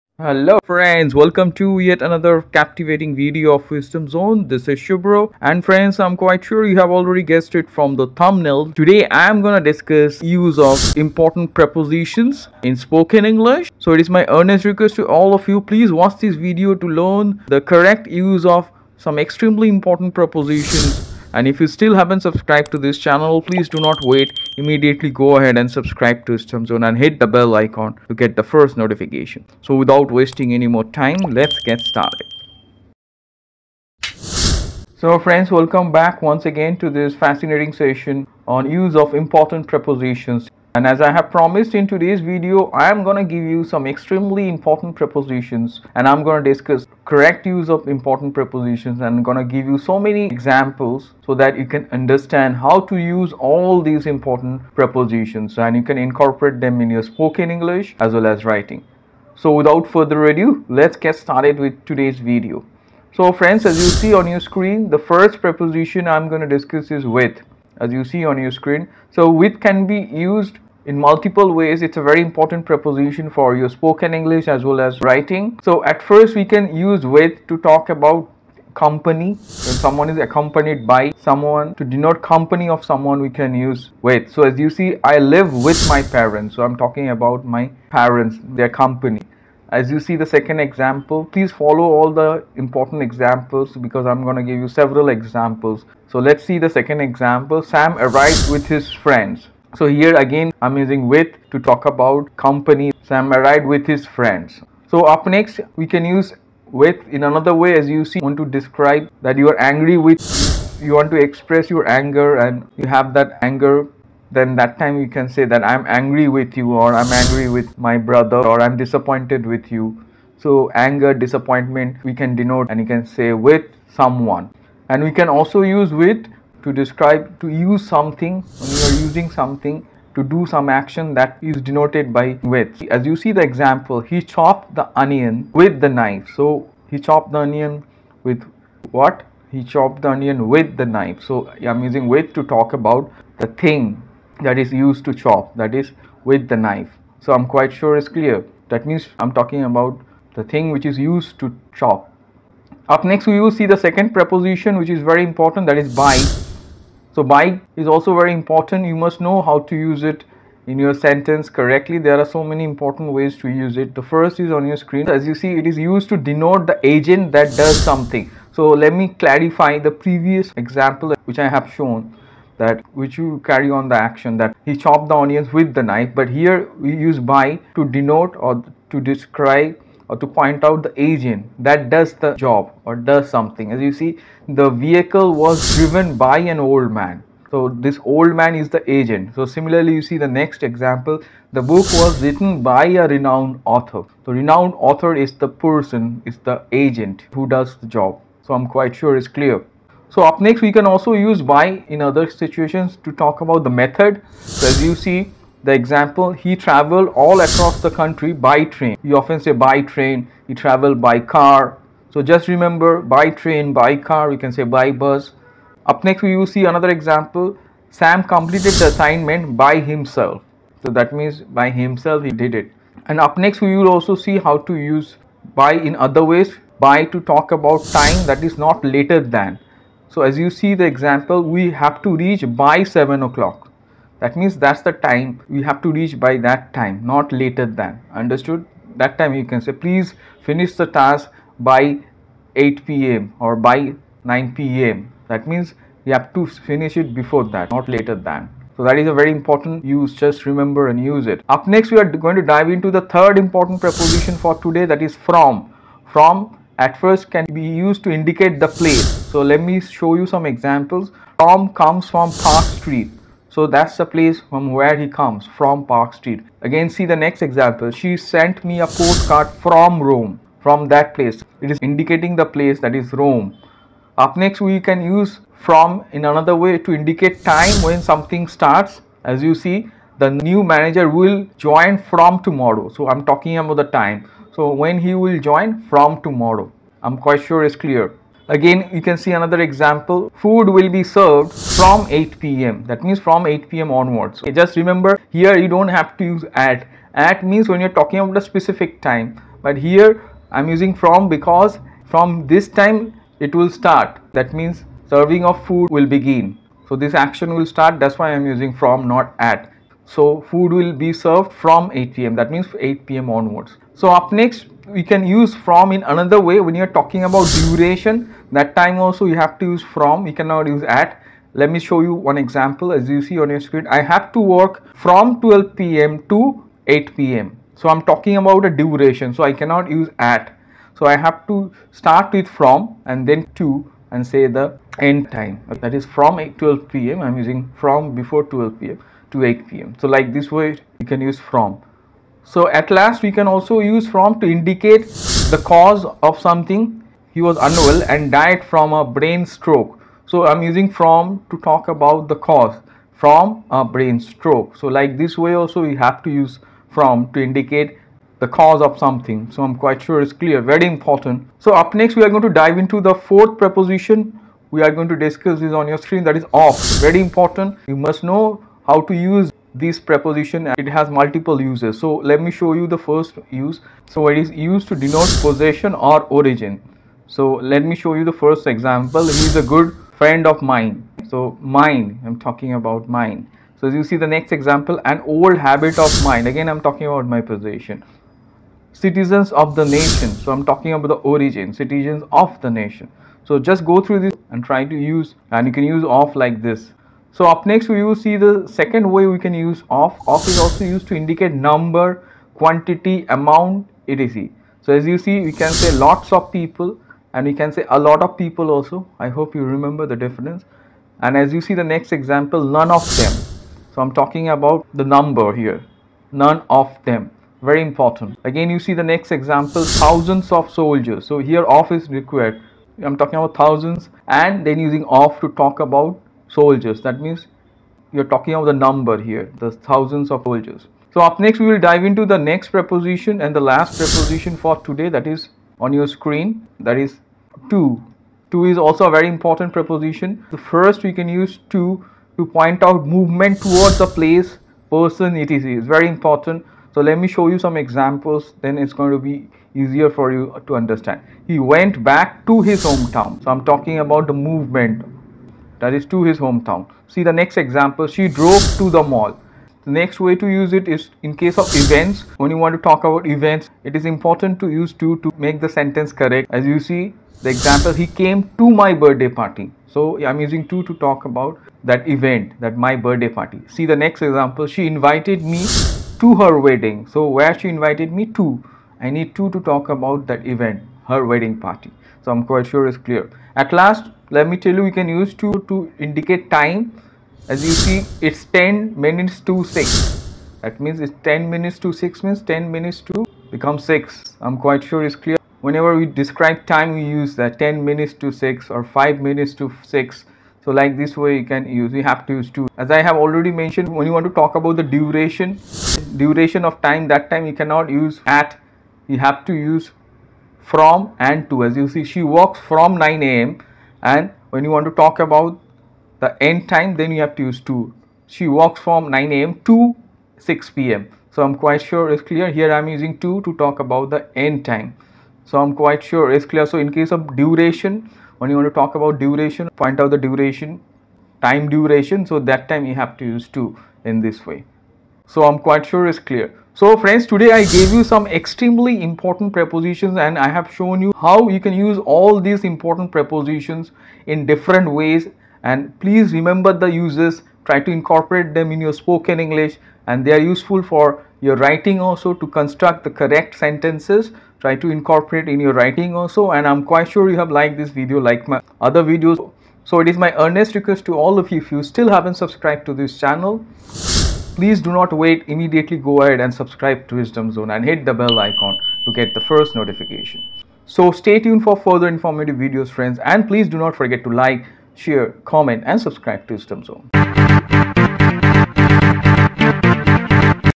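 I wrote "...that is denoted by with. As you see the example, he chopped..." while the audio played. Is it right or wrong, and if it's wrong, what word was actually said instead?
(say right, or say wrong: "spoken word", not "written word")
right.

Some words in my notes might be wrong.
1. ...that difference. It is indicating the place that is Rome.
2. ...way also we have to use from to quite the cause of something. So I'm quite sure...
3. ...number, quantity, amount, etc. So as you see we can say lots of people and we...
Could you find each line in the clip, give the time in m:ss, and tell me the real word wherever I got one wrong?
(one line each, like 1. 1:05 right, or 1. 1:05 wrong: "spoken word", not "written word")
1. 4:30 wrong: "place", not "difference"
2. 5:55 wrong: "indicate", not "quite"
3. 6:41 right.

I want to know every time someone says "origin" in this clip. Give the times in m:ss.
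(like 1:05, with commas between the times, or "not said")
6:16, 6:31.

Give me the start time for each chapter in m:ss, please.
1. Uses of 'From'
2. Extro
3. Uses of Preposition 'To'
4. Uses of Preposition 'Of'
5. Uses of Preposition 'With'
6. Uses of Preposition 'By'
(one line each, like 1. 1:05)
1. 4:15
2. 9:35
3. 7:15
4. 6:07
5. 1:04
6. 2:36.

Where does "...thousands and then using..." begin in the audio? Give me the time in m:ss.
7:03.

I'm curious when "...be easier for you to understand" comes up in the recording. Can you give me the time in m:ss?
7:29.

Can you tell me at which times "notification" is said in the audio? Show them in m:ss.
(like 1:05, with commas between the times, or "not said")
0:28, 9:29.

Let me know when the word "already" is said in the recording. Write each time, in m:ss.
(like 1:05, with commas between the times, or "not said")
0:06, 8:23.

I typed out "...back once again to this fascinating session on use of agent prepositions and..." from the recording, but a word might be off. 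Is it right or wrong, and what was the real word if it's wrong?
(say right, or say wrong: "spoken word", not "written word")
wrong: "important", not "agent".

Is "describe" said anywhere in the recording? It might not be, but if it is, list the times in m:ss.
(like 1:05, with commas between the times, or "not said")
1:48, 2:06, 2:59, 8:16.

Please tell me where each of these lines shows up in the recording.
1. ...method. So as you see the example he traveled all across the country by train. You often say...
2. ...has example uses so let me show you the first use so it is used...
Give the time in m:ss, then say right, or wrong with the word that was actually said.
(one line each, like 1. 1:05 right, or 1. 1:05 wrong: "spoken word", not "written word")
1. 3:23 right
2. 6:10 wrong: "multiple", not "example".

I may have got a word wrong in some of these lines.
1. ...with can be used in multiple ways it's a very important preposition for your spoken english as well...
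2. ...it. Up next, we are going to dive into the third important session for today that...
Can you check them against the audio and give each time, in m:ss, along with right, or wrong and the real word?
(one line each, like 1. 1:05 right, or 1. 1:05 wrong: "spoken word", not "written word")
1. 1:09 right
2. 4:11 wrong: "preposition", not "session".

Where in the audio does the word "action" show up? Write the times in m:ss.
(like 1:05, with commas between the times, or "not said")
2:10, 2:53, 5:07.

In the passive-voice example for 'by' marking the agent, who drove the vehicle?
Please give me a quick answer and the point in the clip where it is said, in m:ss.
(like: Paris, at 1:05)
An old man, at 3:06.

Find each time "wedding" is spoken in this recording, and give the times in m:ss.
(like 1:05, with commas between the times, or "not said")
7:56, 8:01.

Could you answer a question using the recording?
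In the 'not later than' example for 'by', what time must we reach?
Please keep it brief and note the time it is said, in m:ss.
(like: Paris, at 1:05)
7 o'clock, at 3:52.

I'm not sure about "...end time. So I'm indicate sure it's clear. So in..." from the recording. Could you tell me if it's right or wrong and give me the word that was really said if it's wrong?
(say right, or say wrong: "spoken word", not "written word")
wrong: "quite", not "indicate".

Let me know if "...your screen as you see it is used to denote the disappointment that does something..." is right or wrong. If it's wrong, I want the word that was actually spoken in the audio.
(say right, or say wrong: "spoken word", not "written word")
wrong: "agent", not "disappointment".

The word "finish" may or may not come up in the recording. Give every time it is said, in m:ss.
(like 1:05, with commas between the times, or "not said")
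4:00, 4:06.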